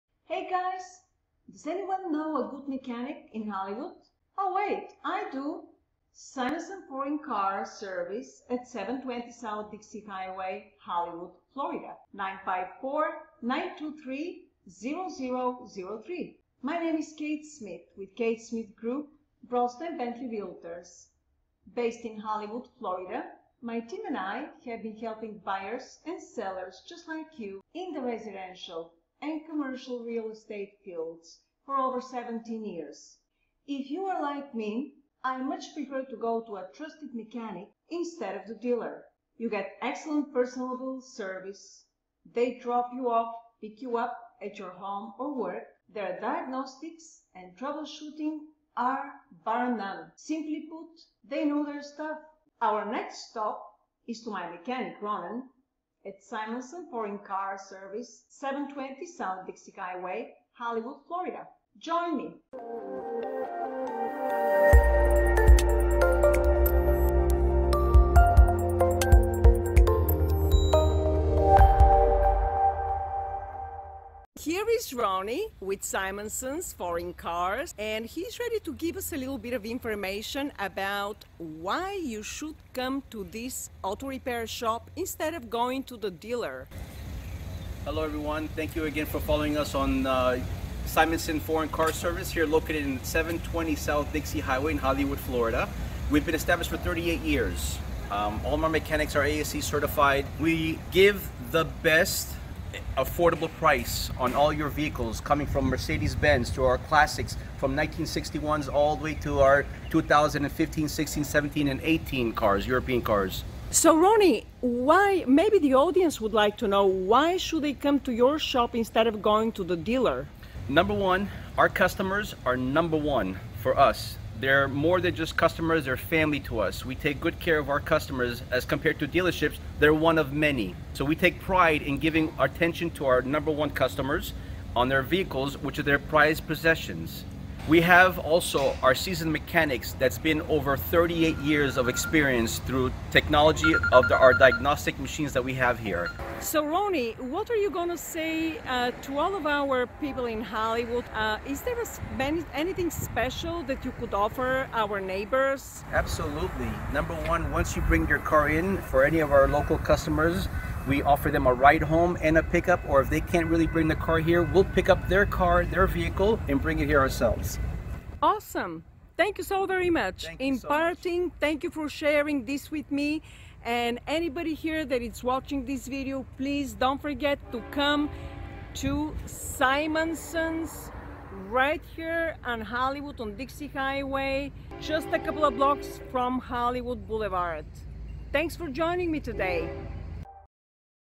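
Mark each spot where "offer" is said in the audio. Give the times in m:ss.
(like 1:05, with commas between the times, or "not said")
2:34, 2:41.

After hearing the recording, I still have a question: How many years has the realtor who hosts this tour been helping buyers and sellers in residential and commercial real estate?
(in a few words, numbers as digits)
17 years.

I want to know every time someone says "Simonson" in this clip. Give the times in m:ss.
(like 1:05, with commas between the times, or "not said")
0:06, 0:56, 1:15, 1:30, 2:59.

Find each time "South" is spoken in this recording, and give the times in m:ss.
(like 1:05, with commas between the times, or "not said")
0:09, 0:59, 1:33.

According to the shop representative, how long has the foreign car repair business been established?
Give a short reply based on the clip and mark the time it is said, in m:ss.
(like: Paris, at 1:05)
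38 years, at 1:36.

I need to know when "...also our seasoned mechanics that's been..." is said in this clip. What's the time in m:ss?
2:18.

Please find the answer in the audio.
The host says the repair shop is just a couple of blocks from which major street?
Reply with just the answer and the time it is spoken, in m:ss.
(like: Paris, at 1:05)
Hollywood Boulevard, at 3:06.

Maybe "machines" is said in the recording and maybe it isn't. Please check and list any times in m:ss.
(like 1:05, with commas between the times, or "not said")
2:24.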